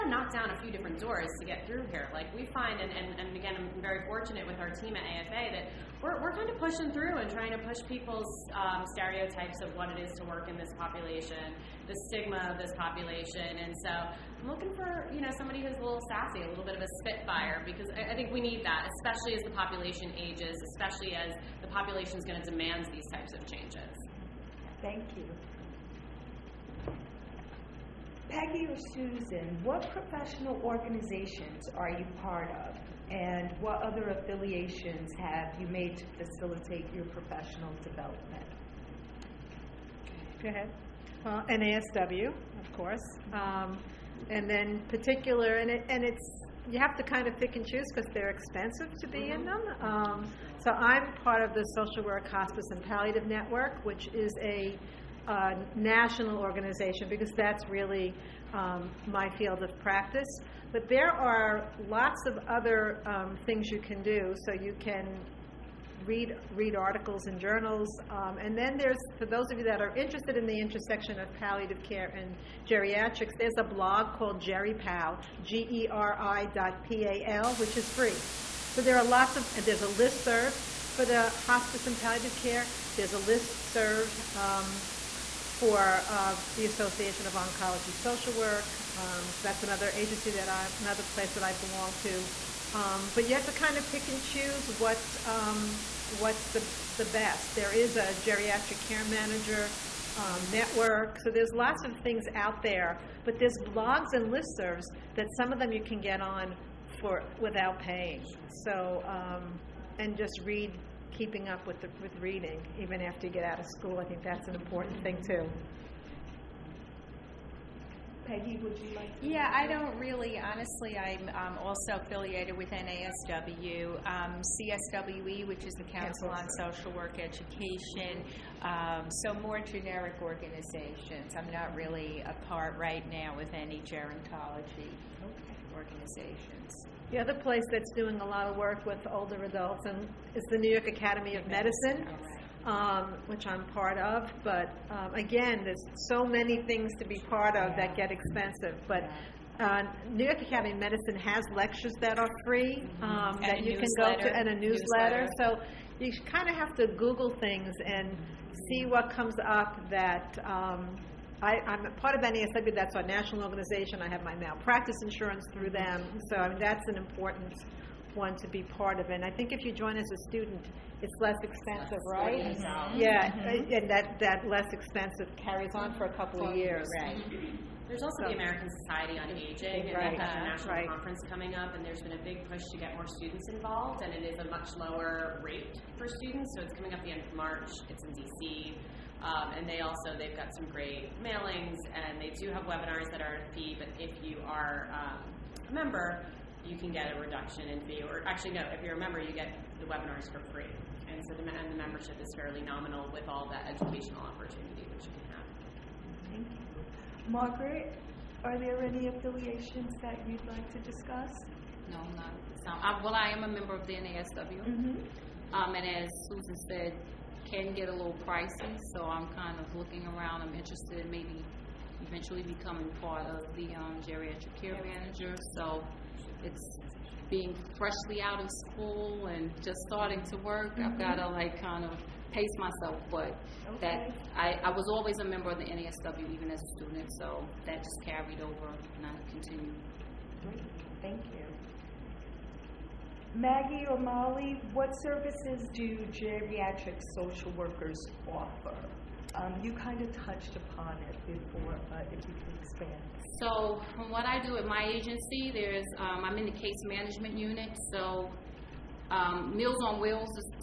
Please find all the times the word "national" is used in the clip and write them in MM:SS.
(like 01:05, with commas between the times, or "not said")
00:55, 02:43, 03:00.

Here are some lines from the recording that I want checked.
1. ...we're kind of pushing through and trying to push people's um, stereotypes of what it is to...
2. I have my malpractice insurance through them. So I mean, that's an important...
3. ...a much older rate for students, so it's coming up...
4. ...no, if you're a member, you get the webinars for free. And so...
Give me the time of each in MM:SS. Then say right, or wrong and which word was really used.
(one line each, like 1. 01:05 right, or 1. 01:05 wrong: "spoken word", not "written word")
1. 00:06 right
2. 02:44 right
3. 03:04 wrong: "lower", not "older"
4. 03:18 right.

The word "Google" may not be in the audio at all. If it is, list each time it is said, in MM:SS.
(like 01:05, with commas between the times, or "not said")
02:36.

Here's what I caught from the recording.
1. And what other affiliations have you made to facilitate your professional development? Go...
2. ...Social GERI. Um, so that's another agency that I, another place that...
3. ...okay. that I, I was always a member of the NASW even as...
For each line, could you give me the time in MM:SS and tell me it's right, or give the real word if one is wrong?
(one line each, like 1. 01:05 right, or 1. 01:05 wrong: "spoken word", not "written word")
1. 00:33 right
2. 01:28 wrong: "Work", not "GERI"
3. 03:53 right.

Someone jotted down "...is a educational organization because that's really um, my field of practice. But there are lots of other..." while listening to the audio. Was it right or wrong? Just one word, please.
wrong.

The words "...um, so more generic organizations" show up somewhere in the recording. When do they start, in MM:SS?
02:08.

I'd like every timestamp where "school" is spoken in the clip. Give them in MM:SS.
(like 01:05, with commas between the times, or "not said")
01:53, 03:48.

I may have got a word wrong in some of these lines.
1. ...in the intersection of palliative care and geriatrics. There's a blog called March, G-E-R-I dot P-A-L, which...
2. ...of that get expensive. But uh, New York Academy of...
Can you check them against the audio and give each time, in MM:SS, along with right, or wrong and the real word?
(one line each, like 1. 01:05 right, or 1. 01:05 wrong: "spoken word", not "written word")
1. 01:10 wrong: "GeriPal", not "March"
2. 02:27 right.